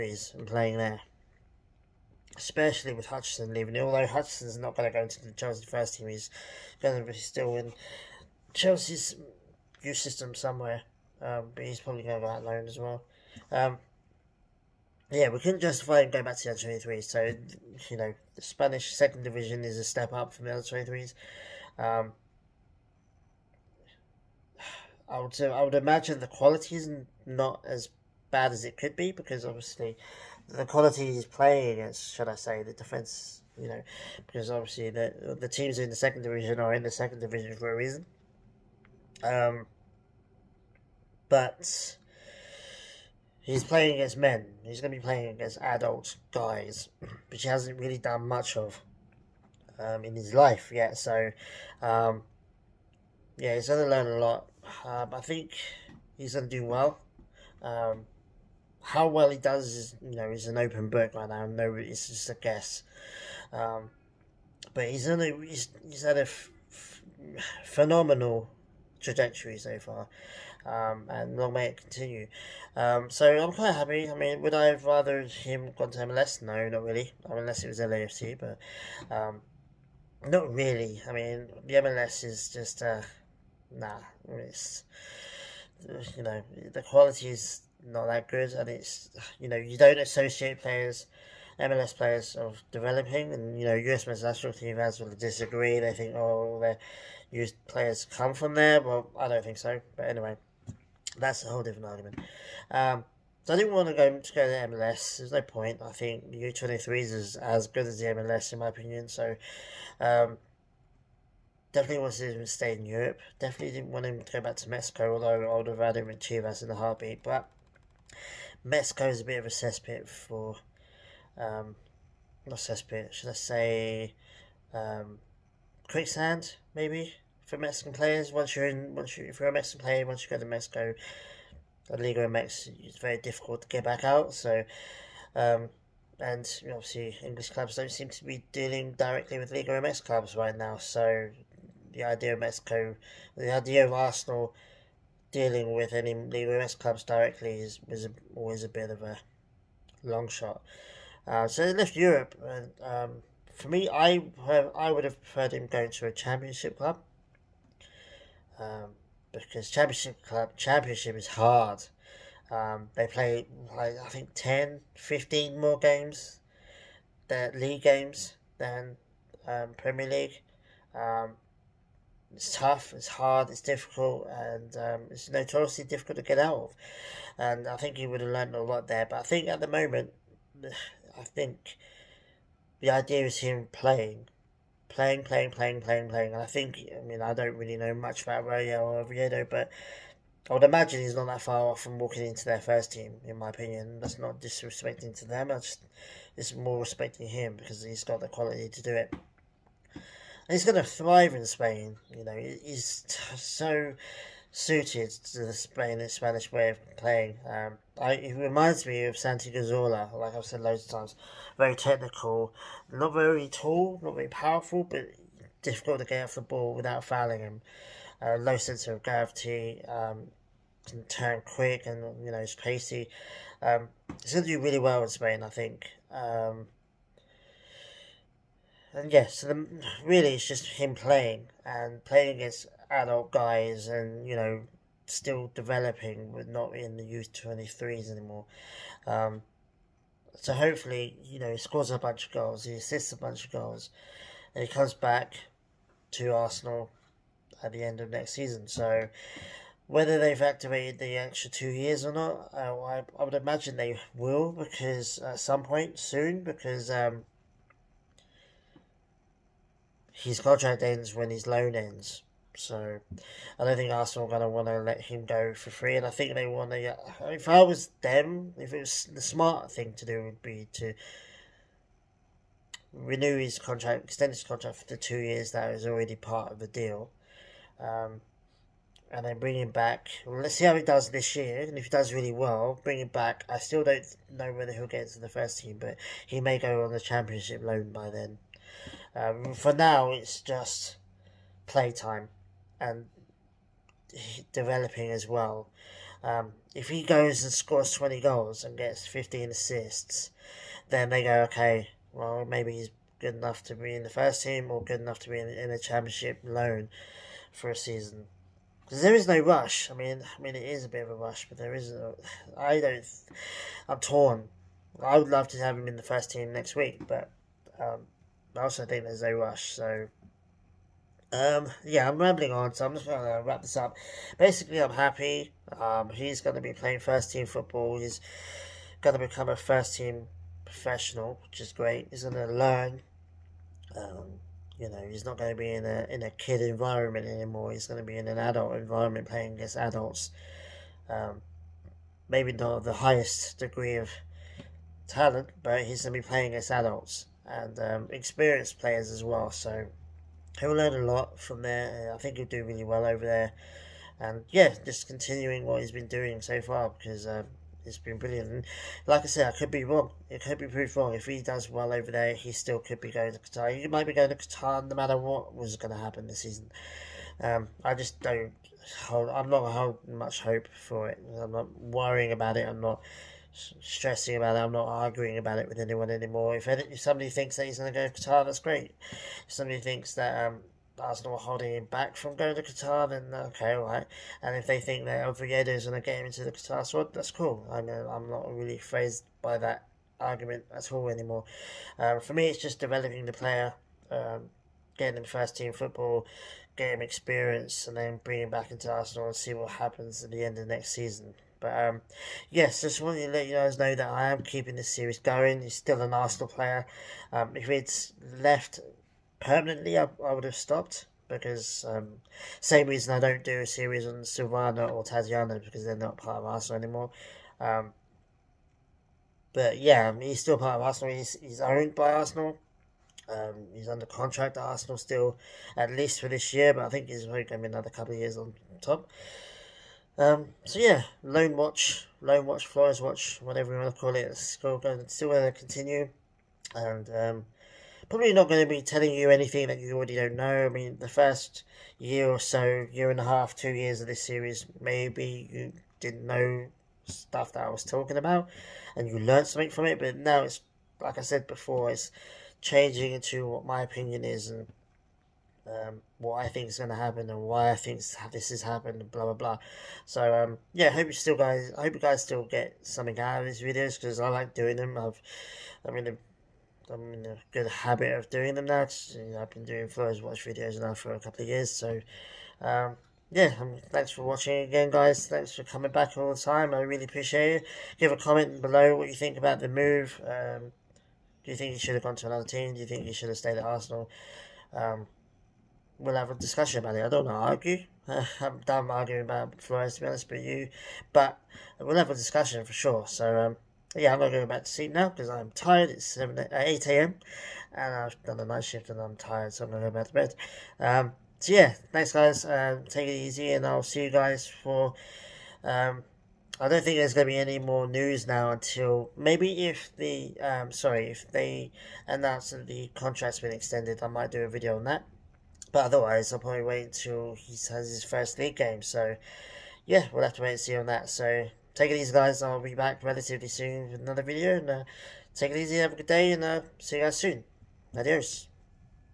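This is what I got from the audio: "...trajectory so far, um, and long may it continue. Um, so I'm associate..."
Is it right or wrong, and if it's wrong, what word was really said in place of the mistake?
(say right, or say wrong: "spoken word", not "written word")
wrong: "quite", not "associate".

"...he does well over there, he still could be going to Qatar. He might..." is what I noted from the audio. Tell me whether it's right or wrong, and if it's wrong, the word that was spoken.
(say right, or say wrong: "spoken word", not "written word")
right.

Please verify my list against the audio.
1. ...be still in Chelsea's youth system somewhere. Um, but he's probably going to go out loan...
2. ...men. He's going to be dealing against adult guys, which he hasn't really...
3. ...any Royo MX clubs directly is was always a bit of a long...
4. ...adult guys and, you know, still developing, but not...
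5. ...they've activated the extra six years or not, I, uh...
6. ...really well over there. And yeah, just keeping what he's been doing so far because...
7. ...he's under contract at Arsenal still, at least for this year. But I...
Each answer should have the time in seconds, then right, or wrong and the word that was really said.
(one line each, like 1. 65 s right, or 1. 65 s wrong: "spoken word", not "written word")
1. 7 s right
2. 44 s wrong: "playing", not "dealing"
3. 145 s wrong: "Liga", not "Royo"
4. 232 s right
5. 250 s wrong: "two", not "six"
6. 352 s wrong: "continuing", not "keeping"
7. 423 s right.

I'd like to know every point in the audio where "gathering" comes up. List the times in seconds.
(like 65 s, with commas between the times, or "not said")
not said.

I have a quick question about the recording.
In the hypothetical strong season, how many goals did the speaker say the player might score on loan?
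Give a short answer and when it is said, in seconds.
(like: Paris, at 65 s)
20, at 297 s.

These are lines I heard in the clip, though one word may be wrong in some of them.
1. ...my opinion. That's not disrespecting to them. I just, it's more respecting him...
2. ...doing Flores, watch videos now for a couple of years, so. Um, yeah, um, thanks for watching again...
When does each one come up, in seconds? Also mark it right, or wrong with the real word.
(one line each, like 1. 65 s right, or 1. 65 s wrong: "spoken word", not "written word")
1. 193 s right
2. 469 s right.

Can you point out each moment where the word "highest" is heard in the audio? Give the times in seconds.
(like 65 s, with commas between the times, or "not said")
342 s.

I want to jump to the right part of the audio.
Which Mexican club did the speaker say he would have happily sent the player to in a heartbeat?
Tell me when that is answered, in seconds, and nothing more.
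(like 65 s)
116 s.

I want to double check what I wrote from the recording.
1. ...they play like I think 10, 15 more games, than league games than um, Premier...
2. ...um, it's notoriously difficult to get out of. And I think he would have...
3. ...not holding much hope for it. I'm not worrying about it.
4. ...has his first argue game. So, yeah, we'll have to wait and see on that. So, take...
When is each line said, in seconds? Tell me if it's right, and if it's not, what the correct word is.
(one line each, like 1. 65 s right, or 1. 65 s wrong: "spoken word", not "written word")
1. 162 s right
2. 174 s right
3. 369 s right
4. 517 s wrong: "league", not "argue".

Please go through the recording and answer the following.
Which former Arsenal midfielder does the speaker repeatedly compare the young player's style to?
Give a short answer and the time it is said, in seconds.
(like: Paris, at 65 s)
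Santi Cazorla, at 209 s.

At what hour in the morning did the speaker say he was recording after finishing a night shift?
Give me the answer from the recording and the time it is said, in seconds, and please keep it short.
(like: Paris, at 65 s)
8 a.m., at 496 s.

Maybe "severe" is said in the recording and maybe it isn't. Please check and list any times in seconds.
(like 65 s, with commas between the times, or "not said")
not said.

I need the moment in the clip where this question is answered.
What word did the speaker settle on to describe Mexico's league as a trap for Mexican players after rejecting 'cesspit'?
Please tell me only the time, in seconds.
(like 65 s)
125 s.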